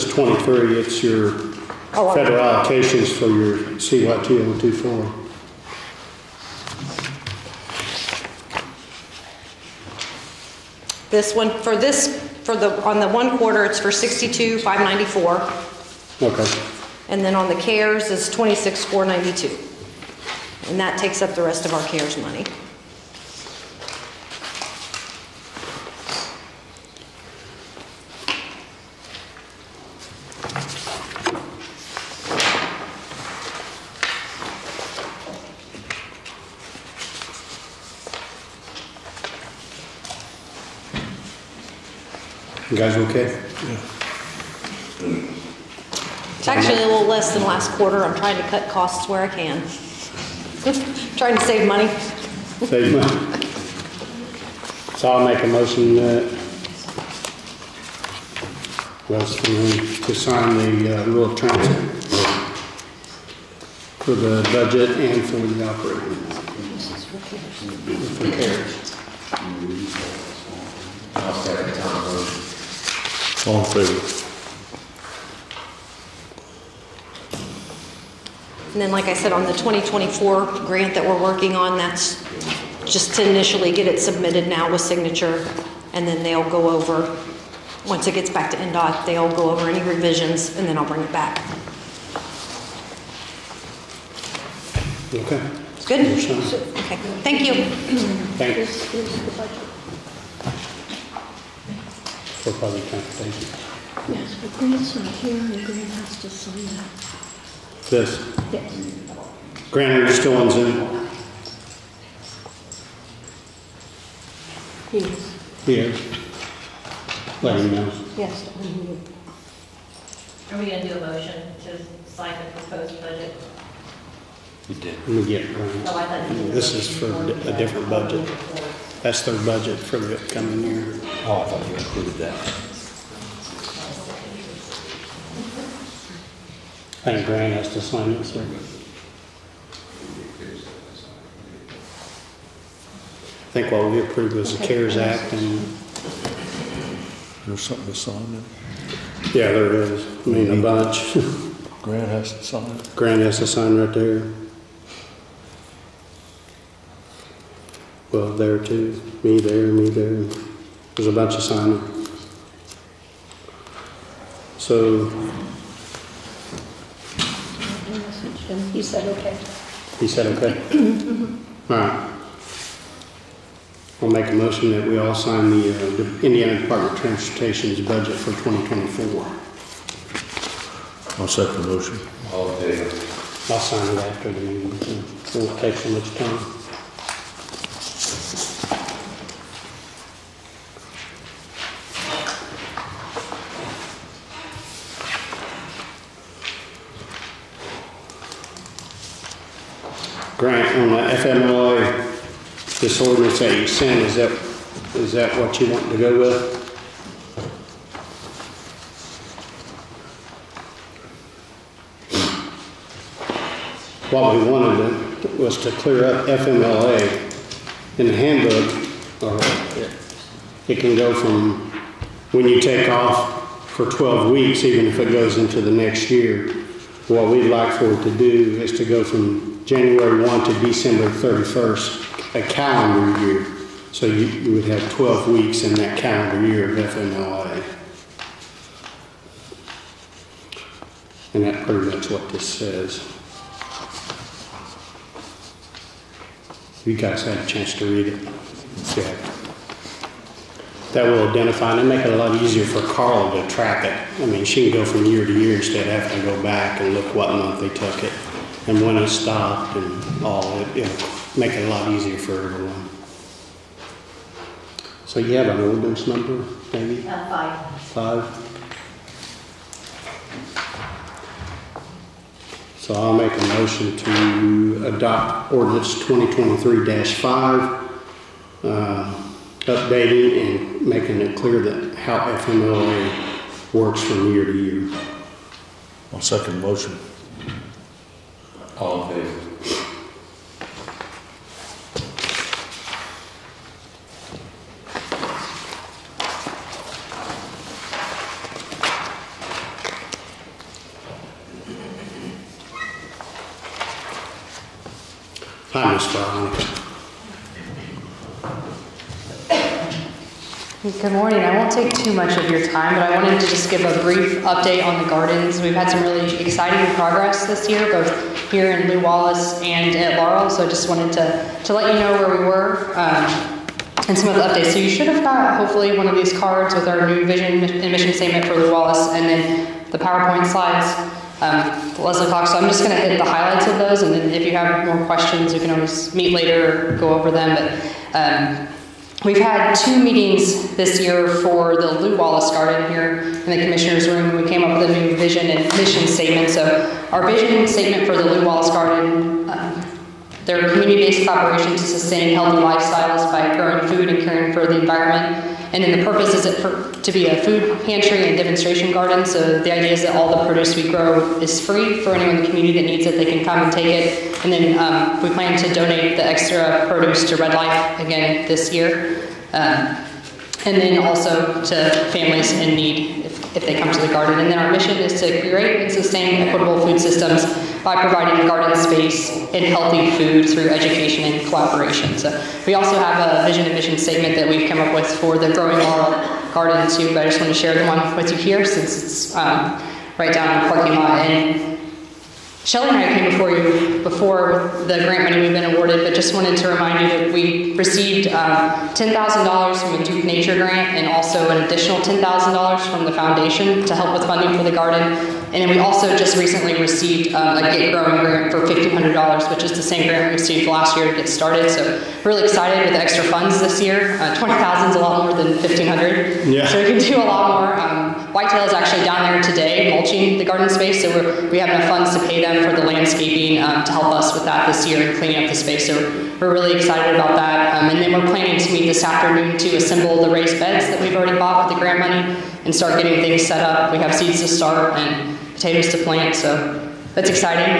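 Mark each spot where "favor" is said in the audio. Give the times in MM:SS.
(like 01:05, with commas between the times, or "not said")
01:13, 03:02, 04:49.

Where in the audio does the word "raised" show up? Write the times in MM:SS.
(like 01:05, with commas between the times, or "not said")
07:10.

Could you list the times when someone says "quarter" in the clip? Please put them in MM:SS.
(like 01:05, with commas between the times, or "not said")
00:13, 00:47.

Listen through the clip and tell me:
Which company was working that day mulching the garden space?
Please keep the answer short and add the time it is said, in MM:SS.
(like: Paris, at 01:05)
Whitetail, at 06:58.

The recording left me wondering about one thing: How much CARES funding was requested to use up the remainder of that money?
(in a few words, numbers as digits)
26,492.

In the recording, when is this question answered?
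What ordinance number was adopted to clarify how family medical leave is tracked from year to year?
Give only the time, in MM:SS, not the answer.
04:36.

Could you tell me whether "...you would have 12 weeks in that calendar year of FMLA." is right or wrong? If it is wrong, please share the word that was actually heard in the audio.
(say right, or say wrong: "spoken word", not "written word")
right.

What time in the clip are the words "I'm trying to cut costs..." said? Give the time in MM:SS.
00:48.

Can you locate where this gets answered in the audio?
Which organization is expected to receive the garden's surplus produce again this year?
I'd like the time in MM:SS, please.
06:07.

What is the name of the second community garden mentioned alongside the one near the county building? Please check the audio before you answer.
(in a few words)
Growing Laurel Garden.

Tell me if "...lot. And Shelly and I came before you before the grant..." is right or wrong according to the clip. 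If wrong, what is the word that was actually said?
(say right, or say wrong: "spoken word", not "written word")
right.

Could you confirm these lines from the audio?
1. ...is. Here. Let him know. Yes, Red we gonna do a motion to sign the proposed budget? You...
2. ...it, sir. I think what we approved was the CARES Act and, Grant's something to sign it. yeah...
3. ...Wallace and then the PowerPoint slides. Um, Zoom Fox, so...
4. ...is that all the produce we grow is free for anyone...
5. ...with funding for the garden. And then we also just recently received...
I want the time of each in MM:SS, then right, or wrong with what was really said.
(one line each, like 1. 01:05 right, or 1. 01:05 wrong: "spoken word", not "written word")
1. 01:54 wrong: "Are", not "Red"
2. 02:18 wrong: "There", not "Grant"
3. 05:28 wrong: "Leslie", not "Zoom"
4. 05:59 right
5. 06:44 right.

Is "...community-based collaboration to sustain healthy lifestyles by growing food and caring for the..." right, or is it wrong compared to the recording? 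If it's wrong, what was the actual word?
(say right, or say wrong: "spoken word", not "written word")
right.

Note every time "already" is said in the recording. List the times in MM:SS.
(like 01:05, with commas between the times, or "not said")
07:11.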